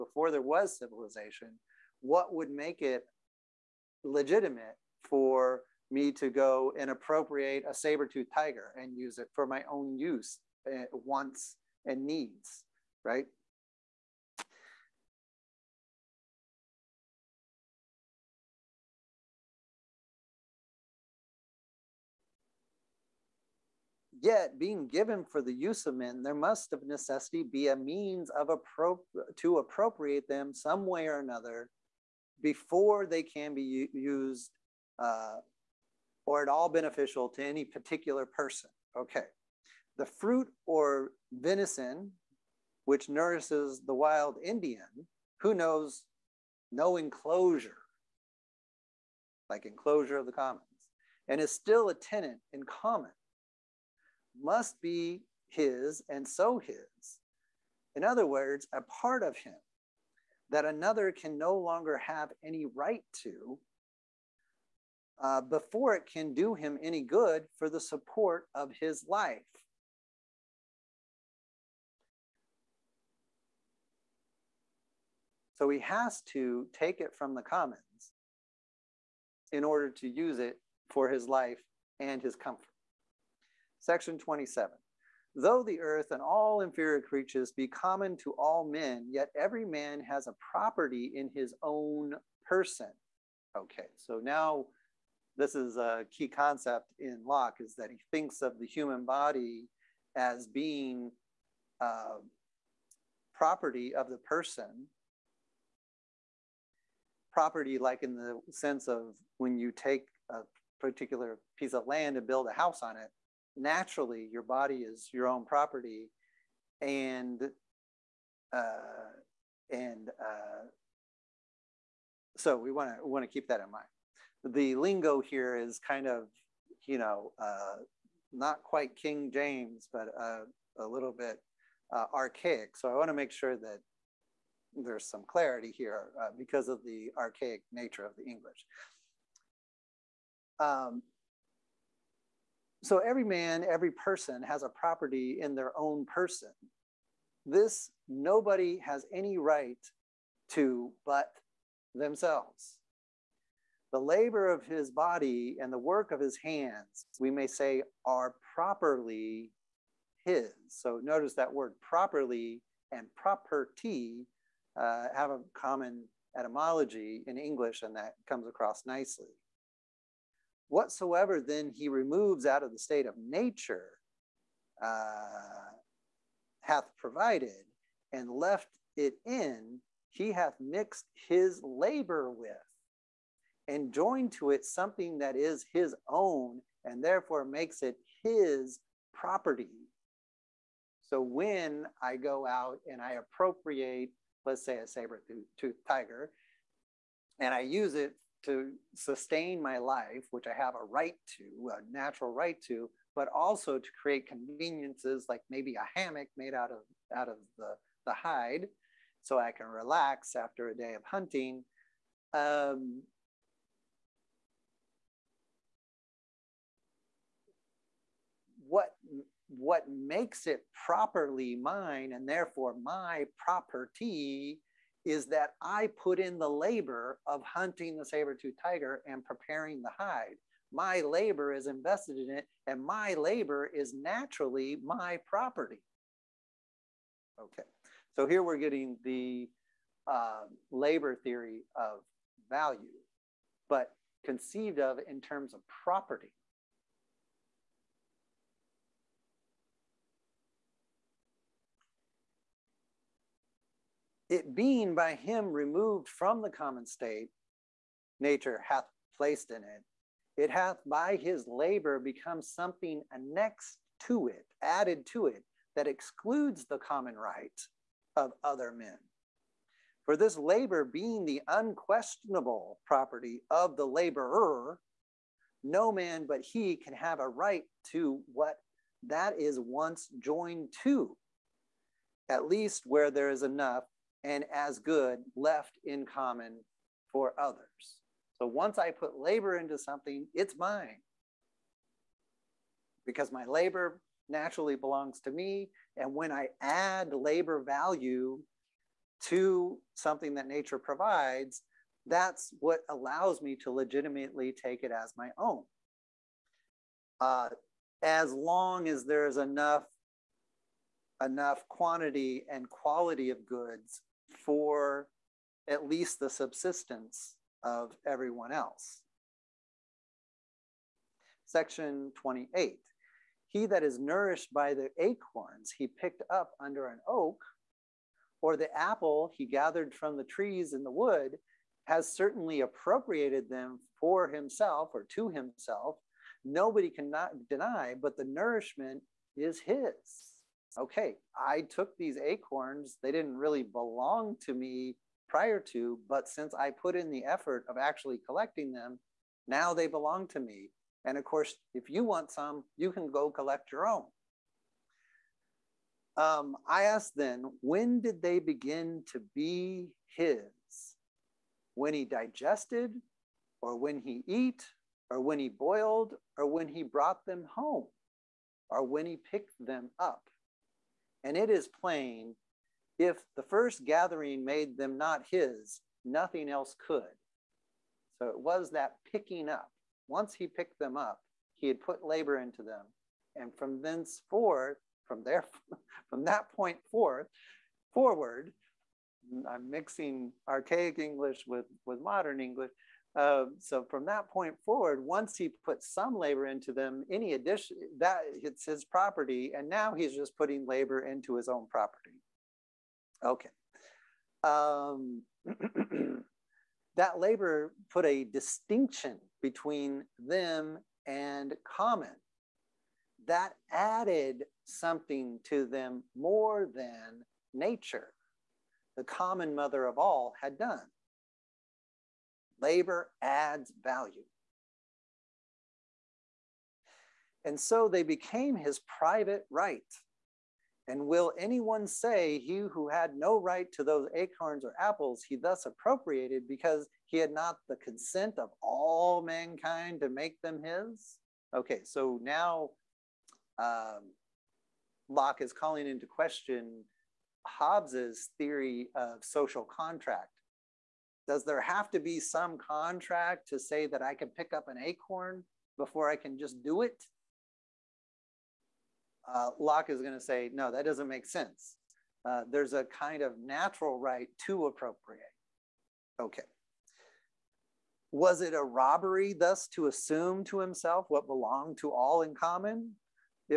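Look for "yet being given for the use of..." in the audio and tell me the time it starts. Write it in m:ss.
0:24.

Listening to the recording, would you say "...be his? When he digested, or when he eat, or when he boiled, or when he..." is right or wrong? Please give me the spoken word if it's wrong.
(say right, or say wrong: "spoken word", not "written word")
right.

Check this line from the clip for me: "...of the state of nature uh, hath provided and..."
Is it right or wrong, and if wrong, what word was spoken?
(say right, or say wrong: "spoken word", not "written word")
right.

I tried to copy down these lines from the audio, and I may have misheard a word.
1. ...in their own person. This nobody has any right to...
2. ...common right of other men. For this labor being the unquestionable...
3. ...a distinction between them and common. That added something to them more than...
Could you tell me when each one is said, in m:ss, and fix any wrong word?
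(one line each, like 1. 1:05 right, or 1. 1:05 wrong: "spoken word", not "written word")
1. 2:25 right
2. 4:26 right
3. 6:48 right.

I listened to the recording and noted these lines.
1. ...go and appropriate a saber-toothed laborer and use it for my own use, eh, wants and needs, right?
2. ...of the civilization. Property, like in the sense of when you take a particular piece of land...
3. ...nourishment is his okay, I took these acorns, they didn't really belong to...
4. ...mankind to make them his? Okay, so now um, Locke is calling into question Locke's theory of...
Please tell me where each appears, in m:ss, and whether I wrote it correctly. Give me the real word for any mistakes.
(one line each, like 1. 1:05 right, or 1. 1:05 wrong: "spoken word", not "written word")
1. 0:06 wrong: "tiger", not "laborer"
2. 1:43 wrong: "person", not "civilization"
3. 5:38 right
4. 7:19 wrong: "Hobbes", not "Locke".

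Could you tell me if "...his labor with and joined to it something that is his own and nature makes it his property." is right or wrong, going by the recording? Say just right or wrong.
wrong.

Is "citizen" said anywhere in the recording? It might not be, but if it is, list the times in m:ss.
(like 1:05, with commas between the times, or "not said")
not said.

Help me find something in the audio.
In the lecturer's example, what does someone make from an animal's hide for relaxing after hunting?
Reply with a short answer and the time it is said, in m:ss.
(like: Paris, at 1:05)
hammock, at 3:25.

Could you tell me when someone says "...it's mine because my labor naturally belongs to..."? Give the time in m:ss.
4:50.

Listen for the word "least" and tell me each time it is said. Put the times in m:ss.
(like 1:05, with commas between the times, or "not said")
4:42, 5:15.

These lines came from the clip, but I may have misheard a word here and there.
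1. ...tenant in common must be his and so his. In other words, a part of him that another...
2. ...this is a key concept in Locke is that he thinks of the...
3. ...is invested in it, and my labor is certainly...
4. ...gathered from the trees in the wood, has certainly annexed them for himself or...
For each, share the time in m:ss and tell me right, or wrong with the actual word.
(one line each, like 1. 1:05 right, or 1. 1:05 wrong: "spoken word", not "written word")
1. 0:51 right
2. 1:35 right
3. 3:51 wrong: "naturally", not "certainly"
4. 5:29 wrong: "appropriated", not "annexed".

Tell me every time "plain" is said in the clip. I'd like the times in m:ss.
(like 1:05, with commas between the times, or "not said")
6:11.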